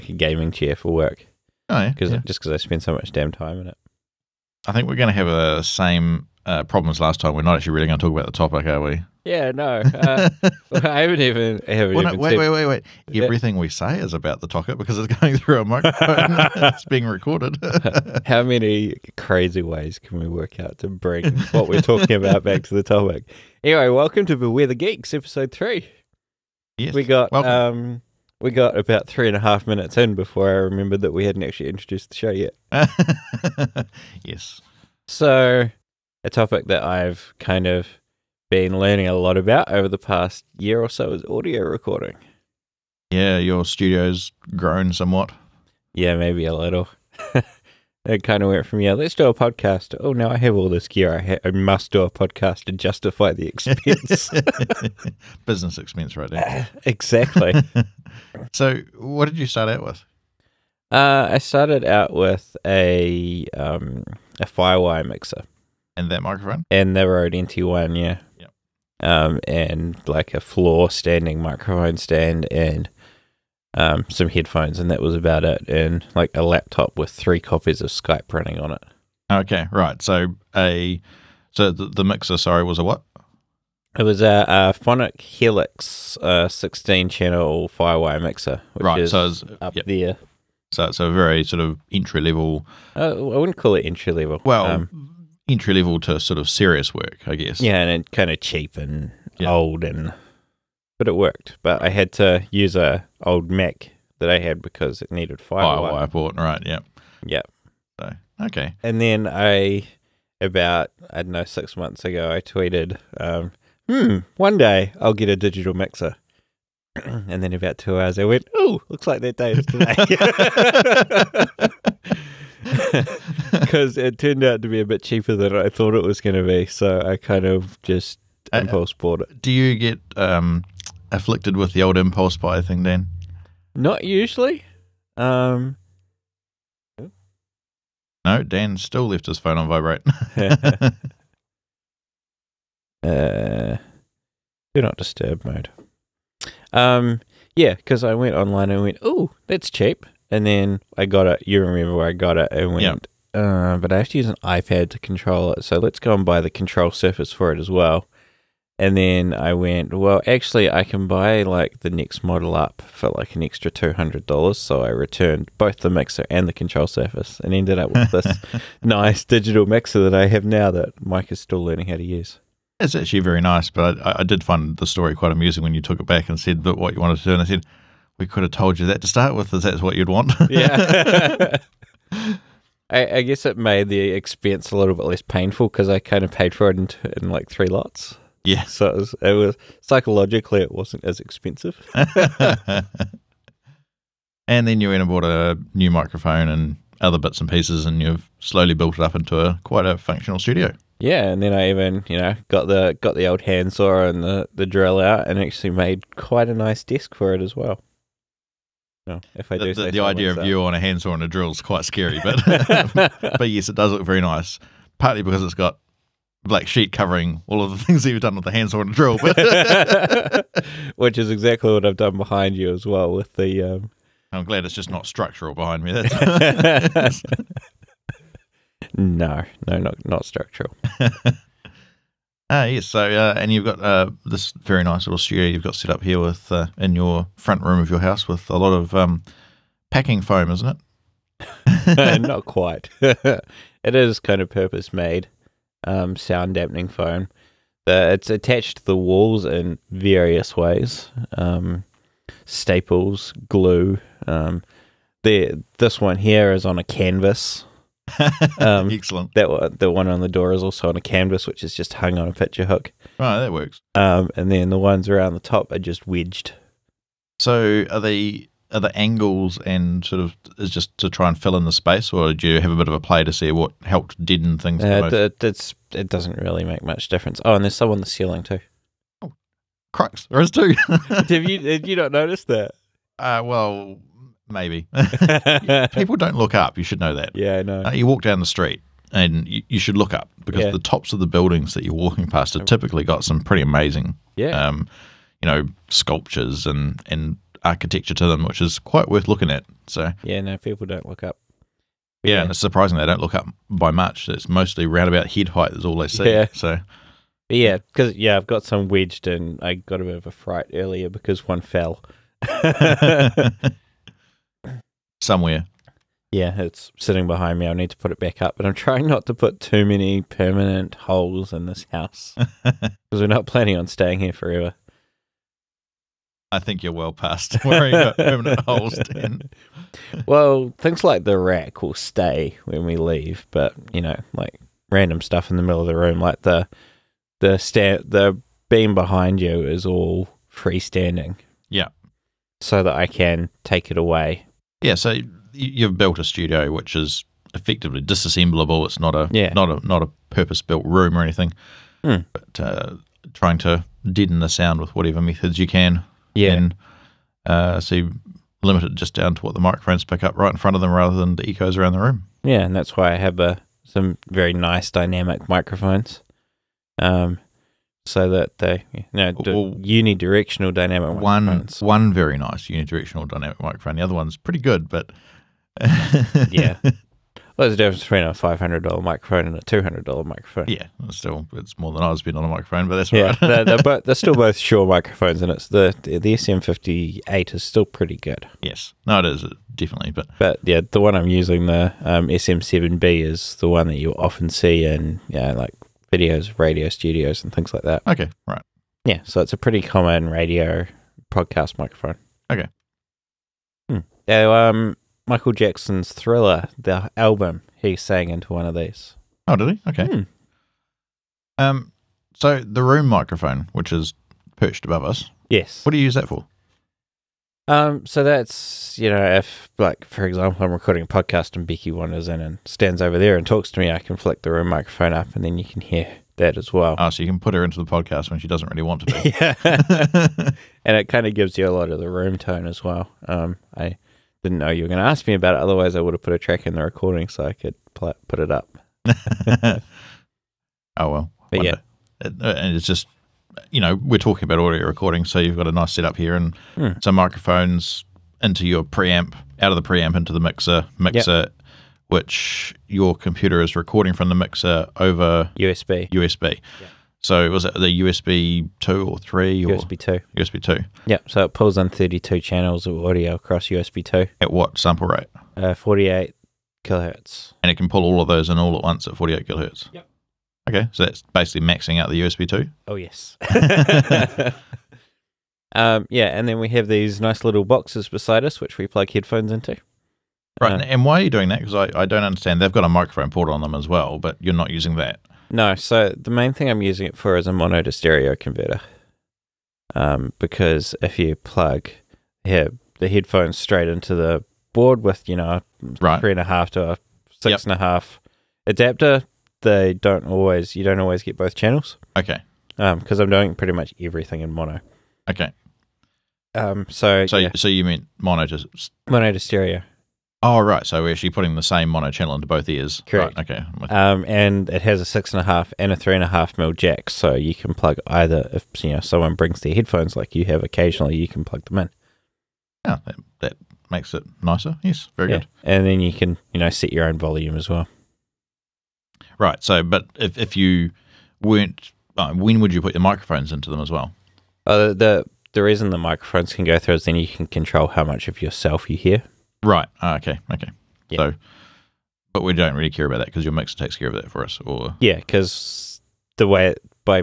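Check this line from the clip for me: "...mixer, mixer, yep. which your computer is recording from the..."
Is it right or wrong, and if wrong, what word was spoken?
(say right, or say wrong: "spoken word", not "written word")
right.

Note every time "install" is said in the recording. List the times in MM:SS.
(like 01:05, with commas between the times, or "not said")
not said.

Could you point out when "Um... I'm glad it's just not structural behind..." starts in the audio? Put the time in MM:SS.
03:43.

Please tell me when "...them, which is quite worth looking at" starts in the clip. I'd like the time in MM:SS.
04:58.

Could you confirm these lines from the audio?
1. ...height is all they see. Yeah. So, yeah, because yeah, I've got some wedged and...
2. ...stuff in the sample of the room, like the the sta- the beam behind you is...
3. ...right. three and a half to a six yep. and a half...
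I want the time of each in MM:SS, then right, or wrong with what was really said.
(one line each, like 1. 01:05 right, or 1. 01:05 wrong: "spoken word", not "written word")
1. 05:05 right
2. 05:35 wrong: "middle", not "sample"
3. 08:15 right.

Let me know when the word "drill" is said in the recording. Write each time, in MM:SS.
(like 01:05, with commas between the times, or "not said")
03:24, 03:31, 03:38.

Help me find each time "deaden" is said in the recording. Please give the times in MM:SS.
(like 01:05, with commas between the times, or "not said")
04:34, 05:54.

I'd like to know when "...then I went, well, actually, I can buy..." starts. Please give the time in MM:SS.
02:38.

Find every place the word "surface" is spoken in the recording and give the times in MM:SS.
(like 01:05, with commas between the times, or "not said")
02:36, 02:46.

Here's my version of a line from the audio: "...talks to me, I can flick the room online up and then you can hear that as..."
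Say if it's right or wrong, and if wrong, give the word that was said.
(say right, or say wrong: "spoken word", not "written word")
wrong: "microphone", not "online".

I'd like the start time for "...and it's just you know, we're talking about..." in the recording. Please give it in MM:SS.
07:22.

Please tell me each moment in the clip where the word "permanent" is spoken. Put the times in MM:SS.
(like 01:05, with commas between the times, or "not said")
05:20, 05:28.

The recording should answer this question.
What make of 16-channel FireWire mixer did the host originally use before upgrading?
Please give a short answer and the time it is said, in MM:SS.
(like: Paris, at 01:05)
Phonic Helix, at 01:24.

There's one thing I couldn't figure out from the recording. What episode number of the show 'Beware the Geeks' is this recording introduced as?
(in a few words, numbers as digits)
3.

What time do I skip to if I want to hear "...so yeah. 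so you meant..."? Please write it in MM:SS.
08:27.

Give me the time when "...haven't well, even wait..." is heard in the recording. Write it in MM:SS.
00:11.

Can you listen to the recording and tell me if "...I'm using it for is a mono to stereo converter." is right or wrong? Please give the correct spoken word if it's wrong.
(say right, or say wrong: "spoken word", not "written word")
right.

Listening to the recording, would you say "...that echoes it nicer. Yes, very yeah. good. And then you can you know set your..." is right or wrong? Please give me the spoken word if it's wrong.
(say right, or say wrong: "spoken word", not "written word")
wrong: "makes", not "echoes".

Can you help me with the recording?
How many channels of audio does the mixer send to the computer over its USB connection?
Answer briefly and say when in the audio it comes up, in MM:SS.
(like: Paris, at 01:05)
32, at 07:41.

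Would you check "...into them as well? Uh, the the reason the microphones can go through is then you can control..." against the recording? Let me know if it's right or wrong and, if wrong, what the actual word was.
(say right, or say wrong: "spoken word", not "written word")
right.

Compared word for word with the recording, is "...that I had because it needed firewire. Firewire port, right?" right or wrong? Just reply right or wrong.
right.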